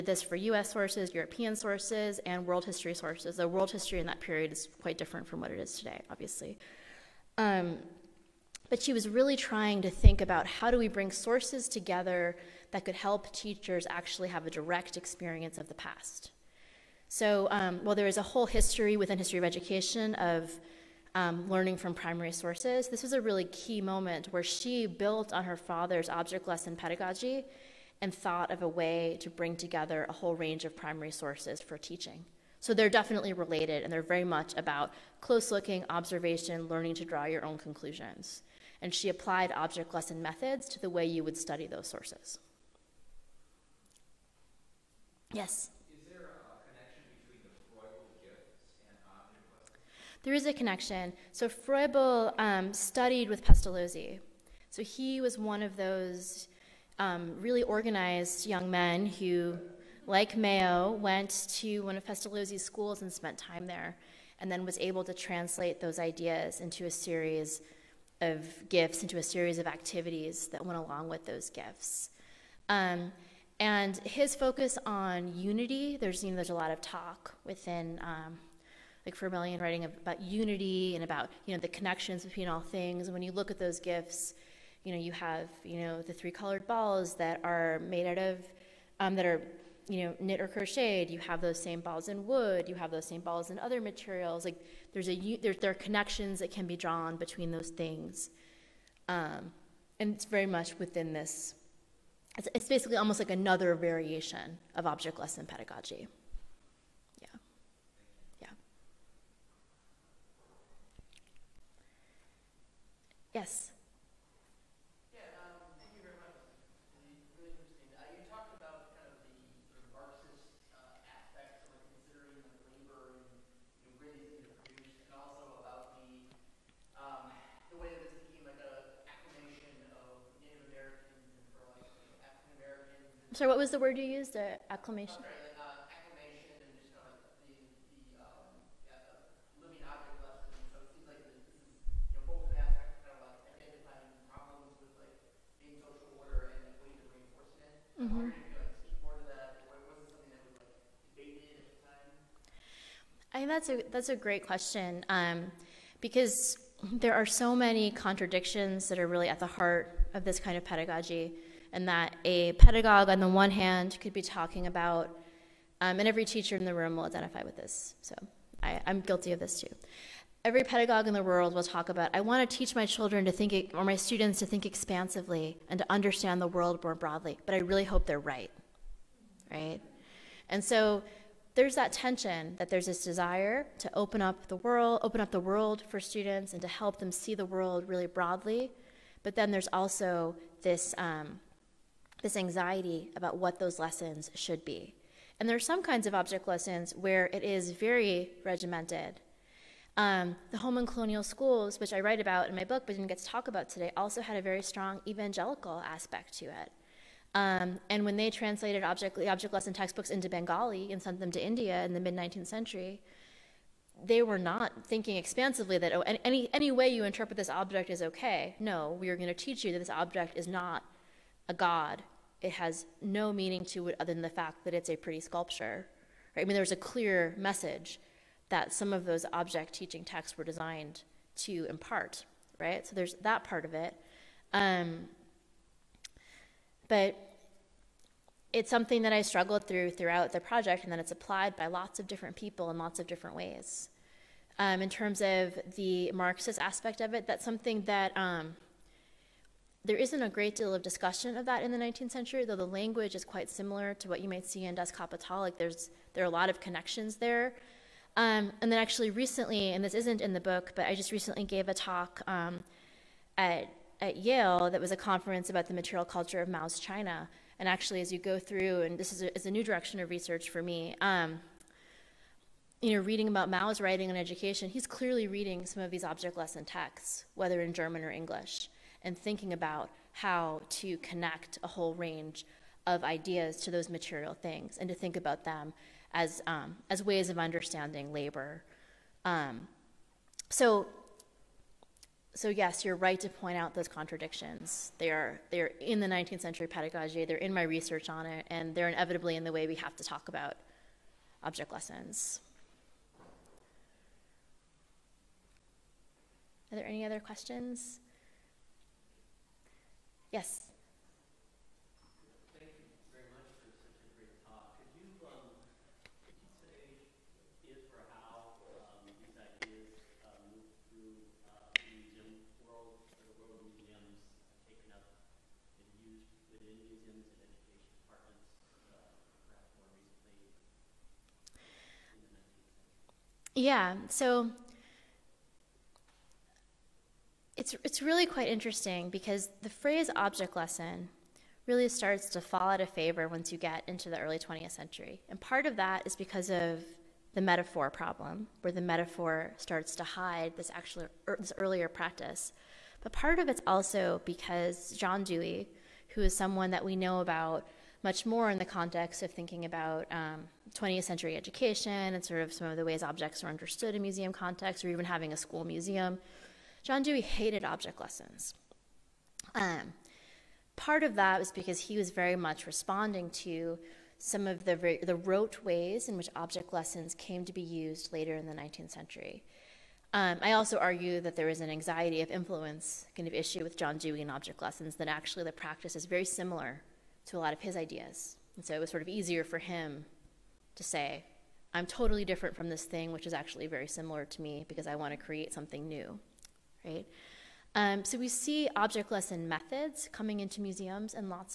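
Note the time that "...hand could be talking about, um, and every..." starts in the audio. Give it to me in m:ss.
2:43.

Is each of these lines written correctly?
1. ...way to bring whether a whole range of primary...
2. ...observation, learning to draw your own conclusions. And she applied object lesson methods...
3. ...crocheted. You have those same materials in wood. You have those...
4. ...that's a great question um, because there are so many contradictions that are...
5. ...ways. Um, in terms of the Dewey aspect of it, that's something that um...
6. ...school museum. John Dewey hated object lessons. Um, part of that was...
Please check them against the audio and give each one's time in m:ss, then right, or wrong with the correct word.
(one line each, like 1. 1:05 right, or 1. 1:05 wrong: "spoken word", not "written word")
1. 0:28 wrong: "together", not "whether"
2. 0:35 right
3. 1:30 wrong: "balls", not "materials"
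4. 2:33 right
5. 4:03 wrong: "Marxist", not "Dewey"
6. 6:05 right.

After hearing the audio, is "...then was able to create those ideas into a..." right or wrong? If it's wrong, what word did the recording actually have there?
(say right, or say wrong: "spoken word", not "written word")
wrong: "translate", not "create".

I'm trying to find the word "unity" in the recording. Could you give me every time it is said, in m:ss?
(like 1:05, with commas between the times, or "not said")
1:15, 1:20.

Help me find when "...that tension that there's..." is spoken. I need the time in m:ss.
3:01.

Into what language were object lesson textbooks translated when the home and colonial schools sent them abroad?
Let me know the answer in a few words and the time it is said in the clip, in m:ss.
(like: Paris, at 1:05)
Bengali, at 3:30.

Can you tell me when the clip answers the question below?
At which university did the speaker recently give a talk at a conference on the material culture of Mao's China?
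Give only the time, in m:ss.
4:24.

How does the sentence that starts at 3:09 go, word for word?
But then there's also this, um, this anxiety about what those lessons should be.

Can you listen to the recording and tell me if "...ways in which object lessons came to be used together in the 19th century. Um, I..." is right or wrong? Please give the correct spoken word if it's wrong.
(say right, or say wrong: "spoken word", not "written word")
wrong: "later", not "together".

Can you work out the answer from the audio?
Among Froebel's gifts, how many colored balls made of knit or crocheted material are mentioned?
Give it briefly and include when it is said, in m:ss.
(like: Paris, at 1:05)
3, at 1:26.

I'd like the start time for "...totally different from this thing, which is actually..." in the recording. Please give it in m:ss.
6:31.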